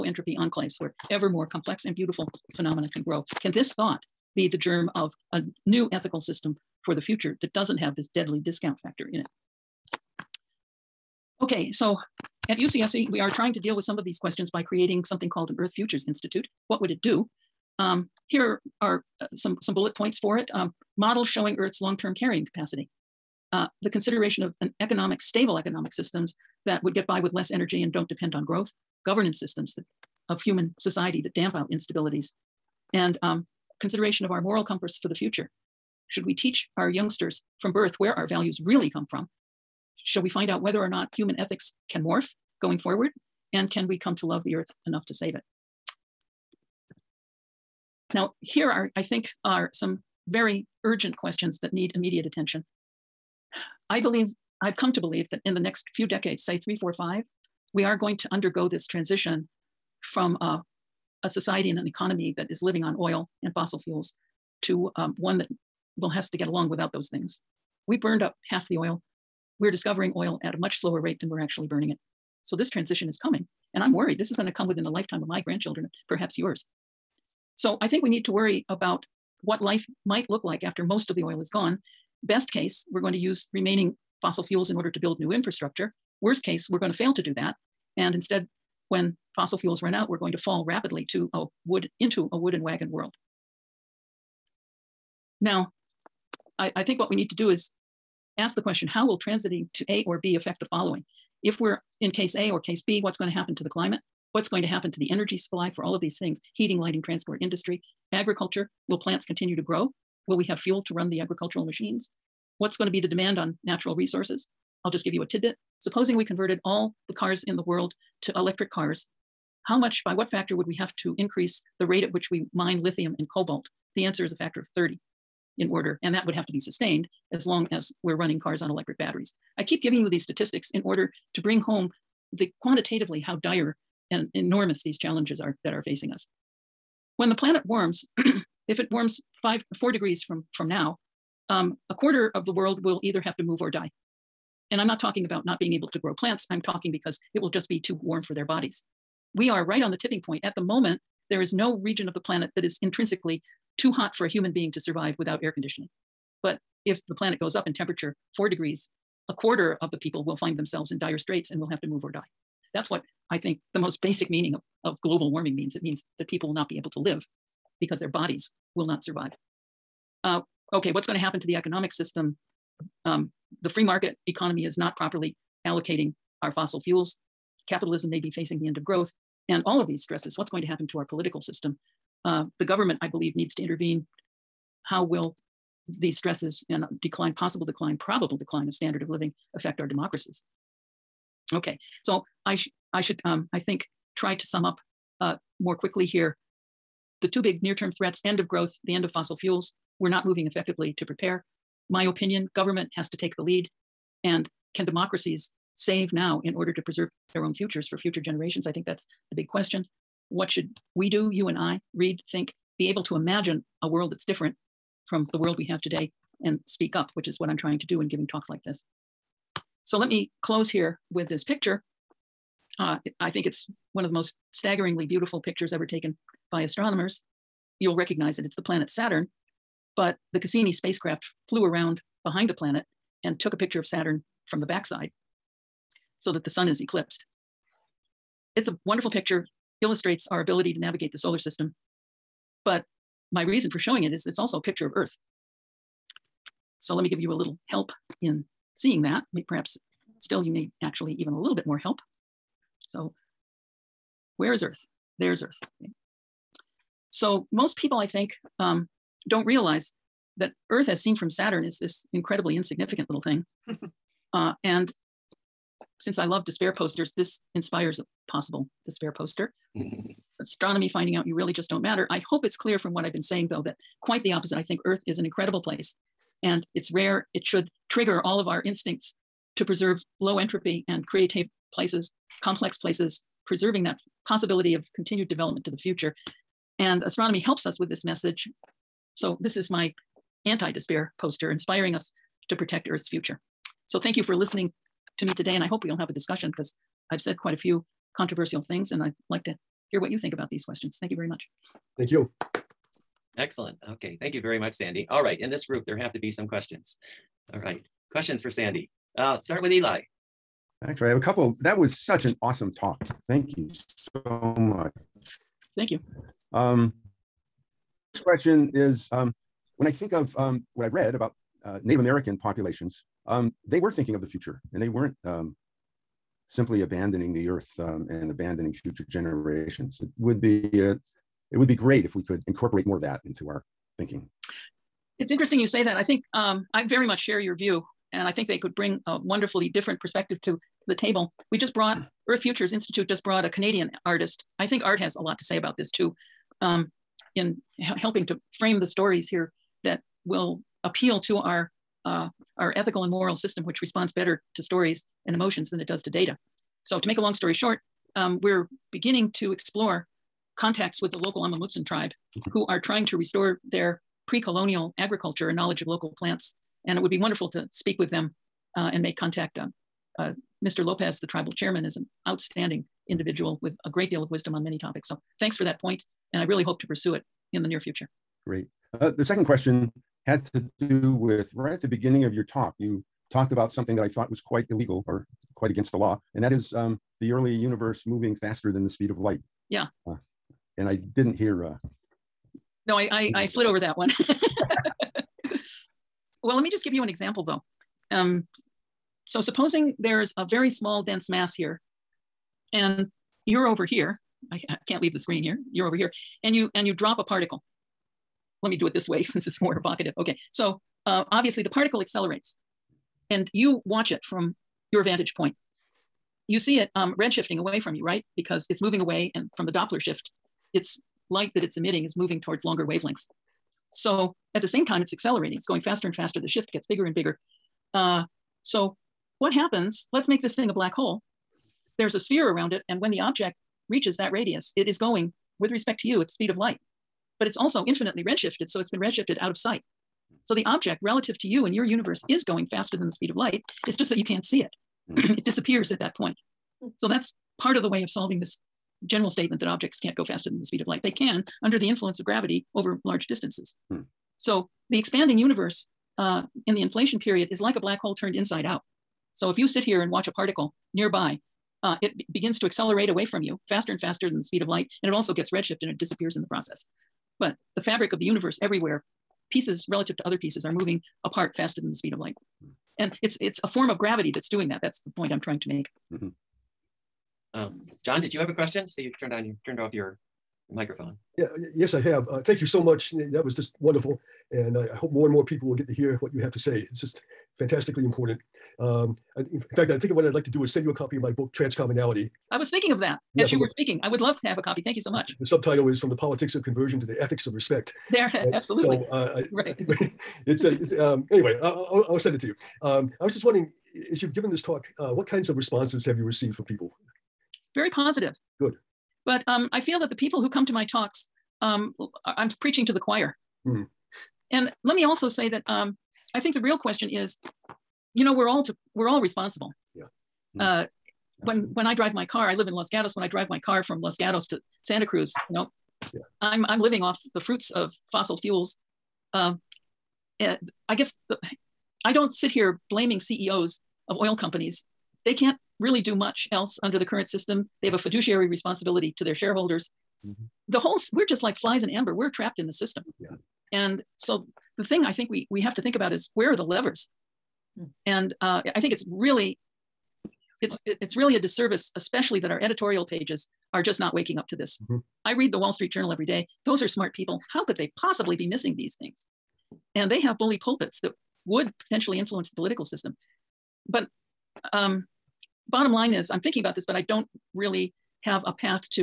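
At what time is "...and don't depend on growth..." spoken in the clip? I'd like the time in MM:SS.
00:27.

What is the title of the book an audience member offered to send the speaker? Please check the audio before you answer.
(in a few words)
Transcommunality.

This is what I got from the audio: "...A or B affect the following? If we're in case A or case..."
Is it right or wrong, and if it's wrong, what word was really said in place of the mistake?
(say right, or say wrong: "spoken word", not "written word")
right.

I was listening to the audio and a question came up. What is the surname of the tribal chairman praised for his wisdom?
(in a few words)
Lopez.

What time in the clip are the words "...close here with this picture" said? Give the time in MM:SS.
03:40.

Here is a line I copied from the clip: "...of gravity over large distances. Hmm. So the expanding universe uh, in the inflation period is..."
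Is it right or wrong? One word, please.
right.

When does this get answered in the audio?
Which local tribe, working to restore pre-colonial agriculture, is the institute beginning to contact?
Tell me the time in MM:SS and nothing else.
06:01.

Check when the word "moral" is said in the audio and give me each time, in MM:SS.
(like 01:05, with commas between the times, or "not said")
00:34, 05:53.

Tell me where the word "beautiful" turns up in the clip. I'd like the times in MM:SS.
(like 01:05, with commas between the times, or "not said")
00:01, 03:45.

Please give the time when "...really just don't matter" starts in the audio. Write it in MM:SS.
04:31.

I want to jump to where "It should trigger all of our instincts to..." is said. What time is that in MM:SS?
04:37.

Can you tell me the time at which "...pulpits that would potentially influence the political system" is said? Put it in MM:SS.
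09:20.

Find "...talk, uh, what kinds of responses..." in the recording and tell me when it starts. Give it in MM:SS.
08:24.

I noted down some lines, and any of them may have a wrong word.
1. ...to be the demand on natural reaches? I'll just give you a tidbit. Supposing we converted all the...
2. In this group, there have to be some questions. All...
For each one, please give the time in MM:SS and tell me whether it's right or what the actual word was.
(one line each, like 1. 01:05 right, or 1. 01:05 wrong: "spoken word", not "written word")
1. 01:52 wrong: "resources", not "reaches"
2. 05:05 right.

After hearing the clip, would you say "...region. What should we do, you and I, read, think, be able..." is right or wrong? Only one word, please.
wrong.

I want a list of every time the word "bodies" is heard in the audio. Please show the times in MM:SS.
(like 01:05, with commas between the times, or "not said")
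02:28, 02:48.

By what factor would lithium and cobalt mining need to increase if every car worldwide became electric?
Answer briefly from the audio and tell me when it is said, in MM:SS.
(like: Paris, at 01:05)
30, at 02:04.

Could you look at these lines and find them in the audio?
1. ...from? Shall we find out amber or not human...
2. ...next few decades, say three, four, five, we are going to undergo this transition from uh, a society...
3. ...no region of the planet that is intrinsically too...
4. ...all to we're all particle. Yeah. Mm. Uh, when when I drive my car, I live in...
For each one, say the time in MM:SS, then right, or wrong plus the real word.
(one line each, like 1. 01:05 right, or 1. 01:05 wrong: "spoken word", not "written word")
1. 00:39 wrong: "whether", not "amber"
2. 00:55 right
3. 02:31 right
4. 08:38 wrong: "responsible", not "particle".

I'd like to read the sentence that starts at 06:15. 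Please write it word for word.
So thanks for that point, and I really hope to pursue it in the near future.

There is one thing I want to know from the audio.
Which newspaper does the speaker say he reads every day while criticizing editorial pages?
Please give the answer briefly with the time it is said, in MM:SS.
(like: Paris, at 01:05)
The Wall Street Journal, at 09:15.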